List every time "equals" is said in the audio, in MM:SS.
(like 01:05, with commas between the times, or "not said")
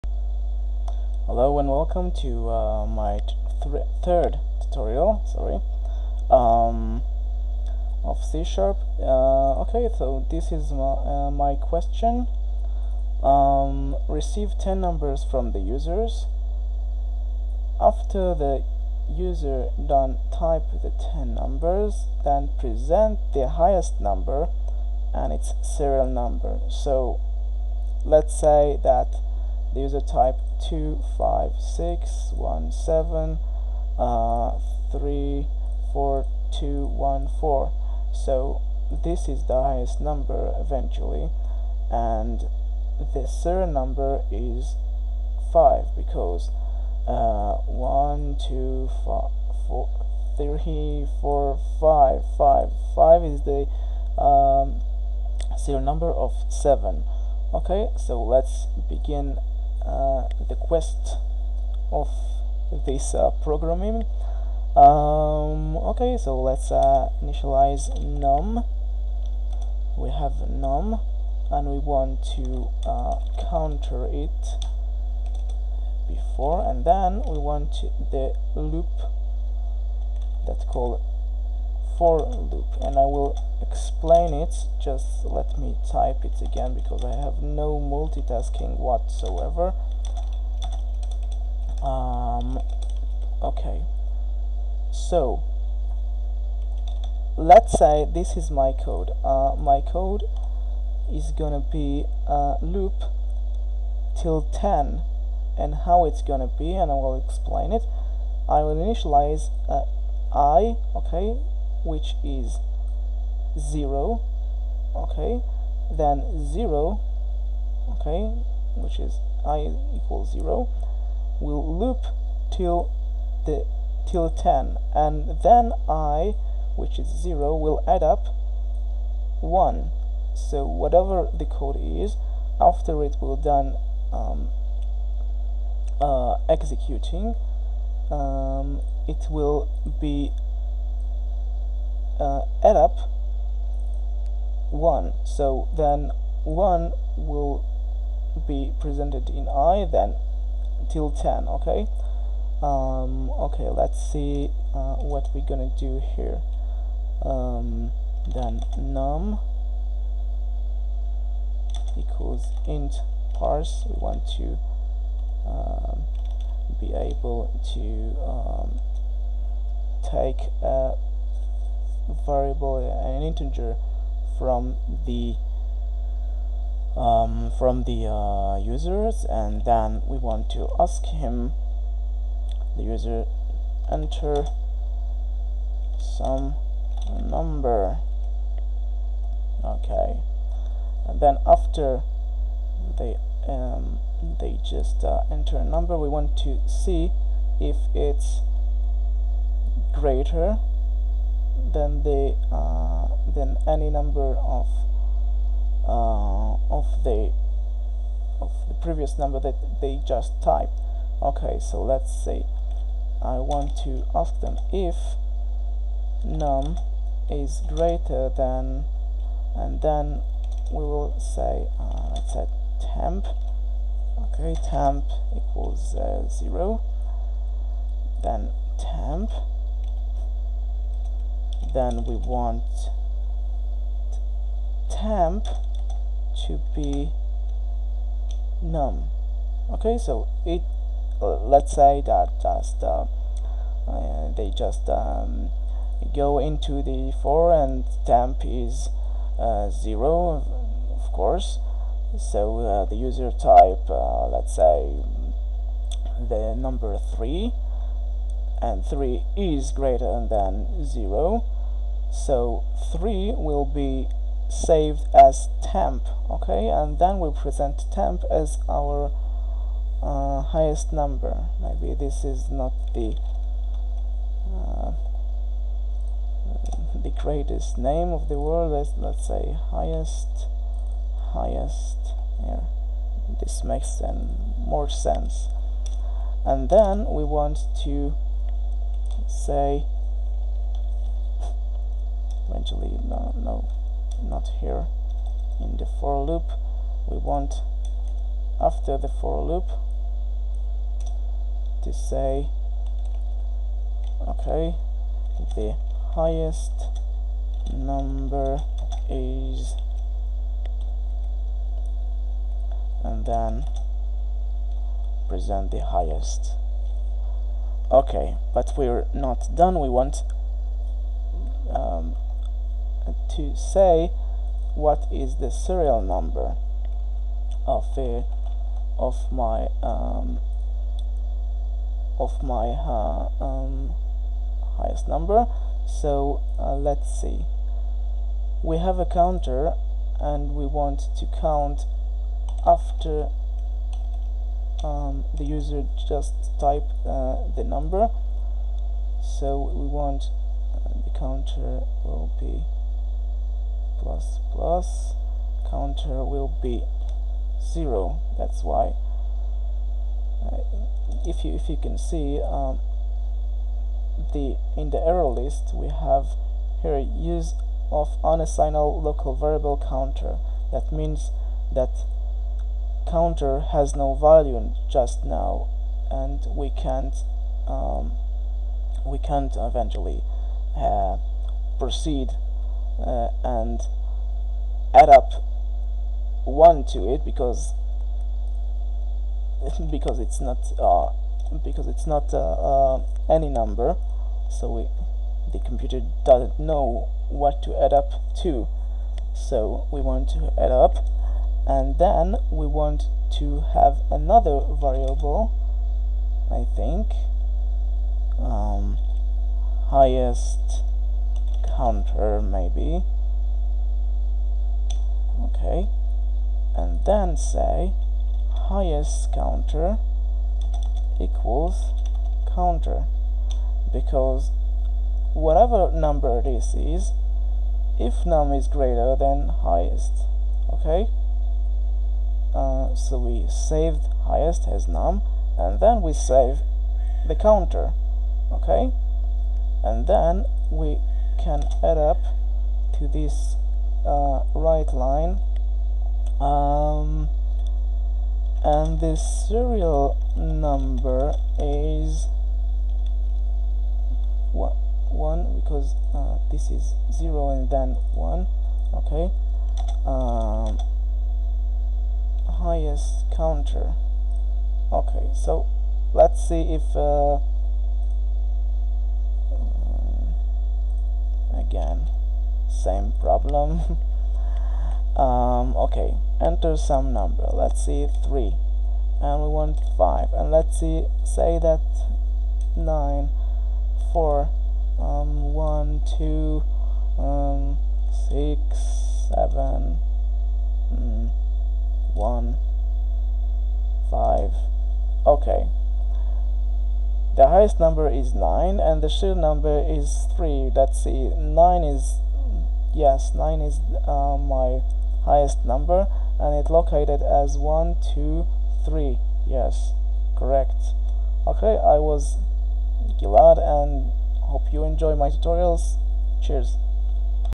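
01:59, 02:41, 03:45, 07:01.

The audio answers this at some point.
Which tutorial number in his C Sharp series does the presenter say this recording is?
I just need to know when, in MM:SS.
00:04.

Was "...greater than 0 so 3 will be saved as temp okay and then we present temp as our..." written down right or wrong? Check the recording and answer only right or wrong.
right.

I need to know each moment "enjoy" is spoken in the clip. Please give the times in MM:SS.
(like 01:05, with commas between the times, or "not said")
08:34.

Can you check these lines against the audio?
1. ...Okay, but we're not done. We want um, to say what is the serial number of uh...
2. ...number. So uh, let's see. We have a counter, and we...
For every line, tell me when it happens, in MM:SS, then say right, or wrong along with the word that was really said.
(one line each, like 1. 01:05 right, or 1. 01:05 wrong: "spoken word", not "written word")
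1. 05:17 right
2. 05:35 right.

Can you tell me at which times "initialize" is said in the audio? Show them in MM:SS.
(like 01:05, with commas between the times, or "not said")
01:07, 01:48.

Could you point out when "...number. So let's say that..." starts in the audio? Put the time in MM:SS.
00:26.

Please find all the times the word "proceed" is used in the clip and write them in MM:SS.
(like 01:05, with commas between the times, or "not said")
06:21.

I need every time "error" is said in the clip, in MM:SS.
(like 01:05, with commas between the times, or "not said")
06:05.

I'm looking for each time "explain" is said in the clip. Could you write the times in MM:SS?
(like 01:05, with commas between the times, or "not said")
01:23, 01:47.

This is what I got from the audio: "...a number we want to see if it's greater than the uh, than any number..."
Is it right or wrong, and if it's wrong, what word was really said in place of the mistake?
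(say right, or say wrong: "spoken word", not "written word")
right.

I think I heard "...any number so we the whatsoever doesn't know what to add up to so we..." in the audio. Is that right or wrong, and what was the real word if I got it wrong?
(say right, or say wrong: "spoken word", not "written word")
wrong: "computer", not "whatsoever".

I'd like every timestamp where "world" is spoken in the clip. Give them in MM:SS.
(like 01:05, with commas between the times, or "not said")
04:38.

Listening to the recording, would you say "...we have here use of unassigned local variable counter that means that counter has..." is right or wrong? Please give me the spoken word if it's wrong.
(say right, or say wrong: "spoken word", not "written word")
right.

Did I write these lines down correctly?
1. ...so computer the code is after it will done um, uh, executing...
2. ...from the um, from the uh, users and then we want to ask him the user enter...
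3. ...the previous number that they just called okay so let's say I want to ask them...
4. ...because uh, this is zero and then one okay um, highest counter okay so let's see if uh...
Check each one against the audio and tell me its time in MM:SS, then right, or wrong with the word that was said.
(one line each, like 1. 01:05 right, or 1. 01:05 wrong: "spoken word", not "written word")
1. 02:10 wrong: "whatever", not "computer"
2. 02:54 right
3. 03:28 wrong: "typed", not "called"
4. 07:35 right.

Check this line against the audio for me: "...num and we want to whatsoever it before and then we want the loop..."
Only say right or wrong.
wrong.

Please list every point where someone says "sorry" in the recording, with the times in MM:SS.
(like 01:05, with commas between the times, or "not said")
00:05.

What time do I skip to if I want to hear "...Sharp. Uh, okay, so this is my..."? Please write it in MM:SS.
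00:08.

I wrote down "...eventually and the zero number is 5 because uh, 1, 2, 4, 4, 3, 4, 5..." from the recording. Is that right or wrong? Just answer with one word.
right.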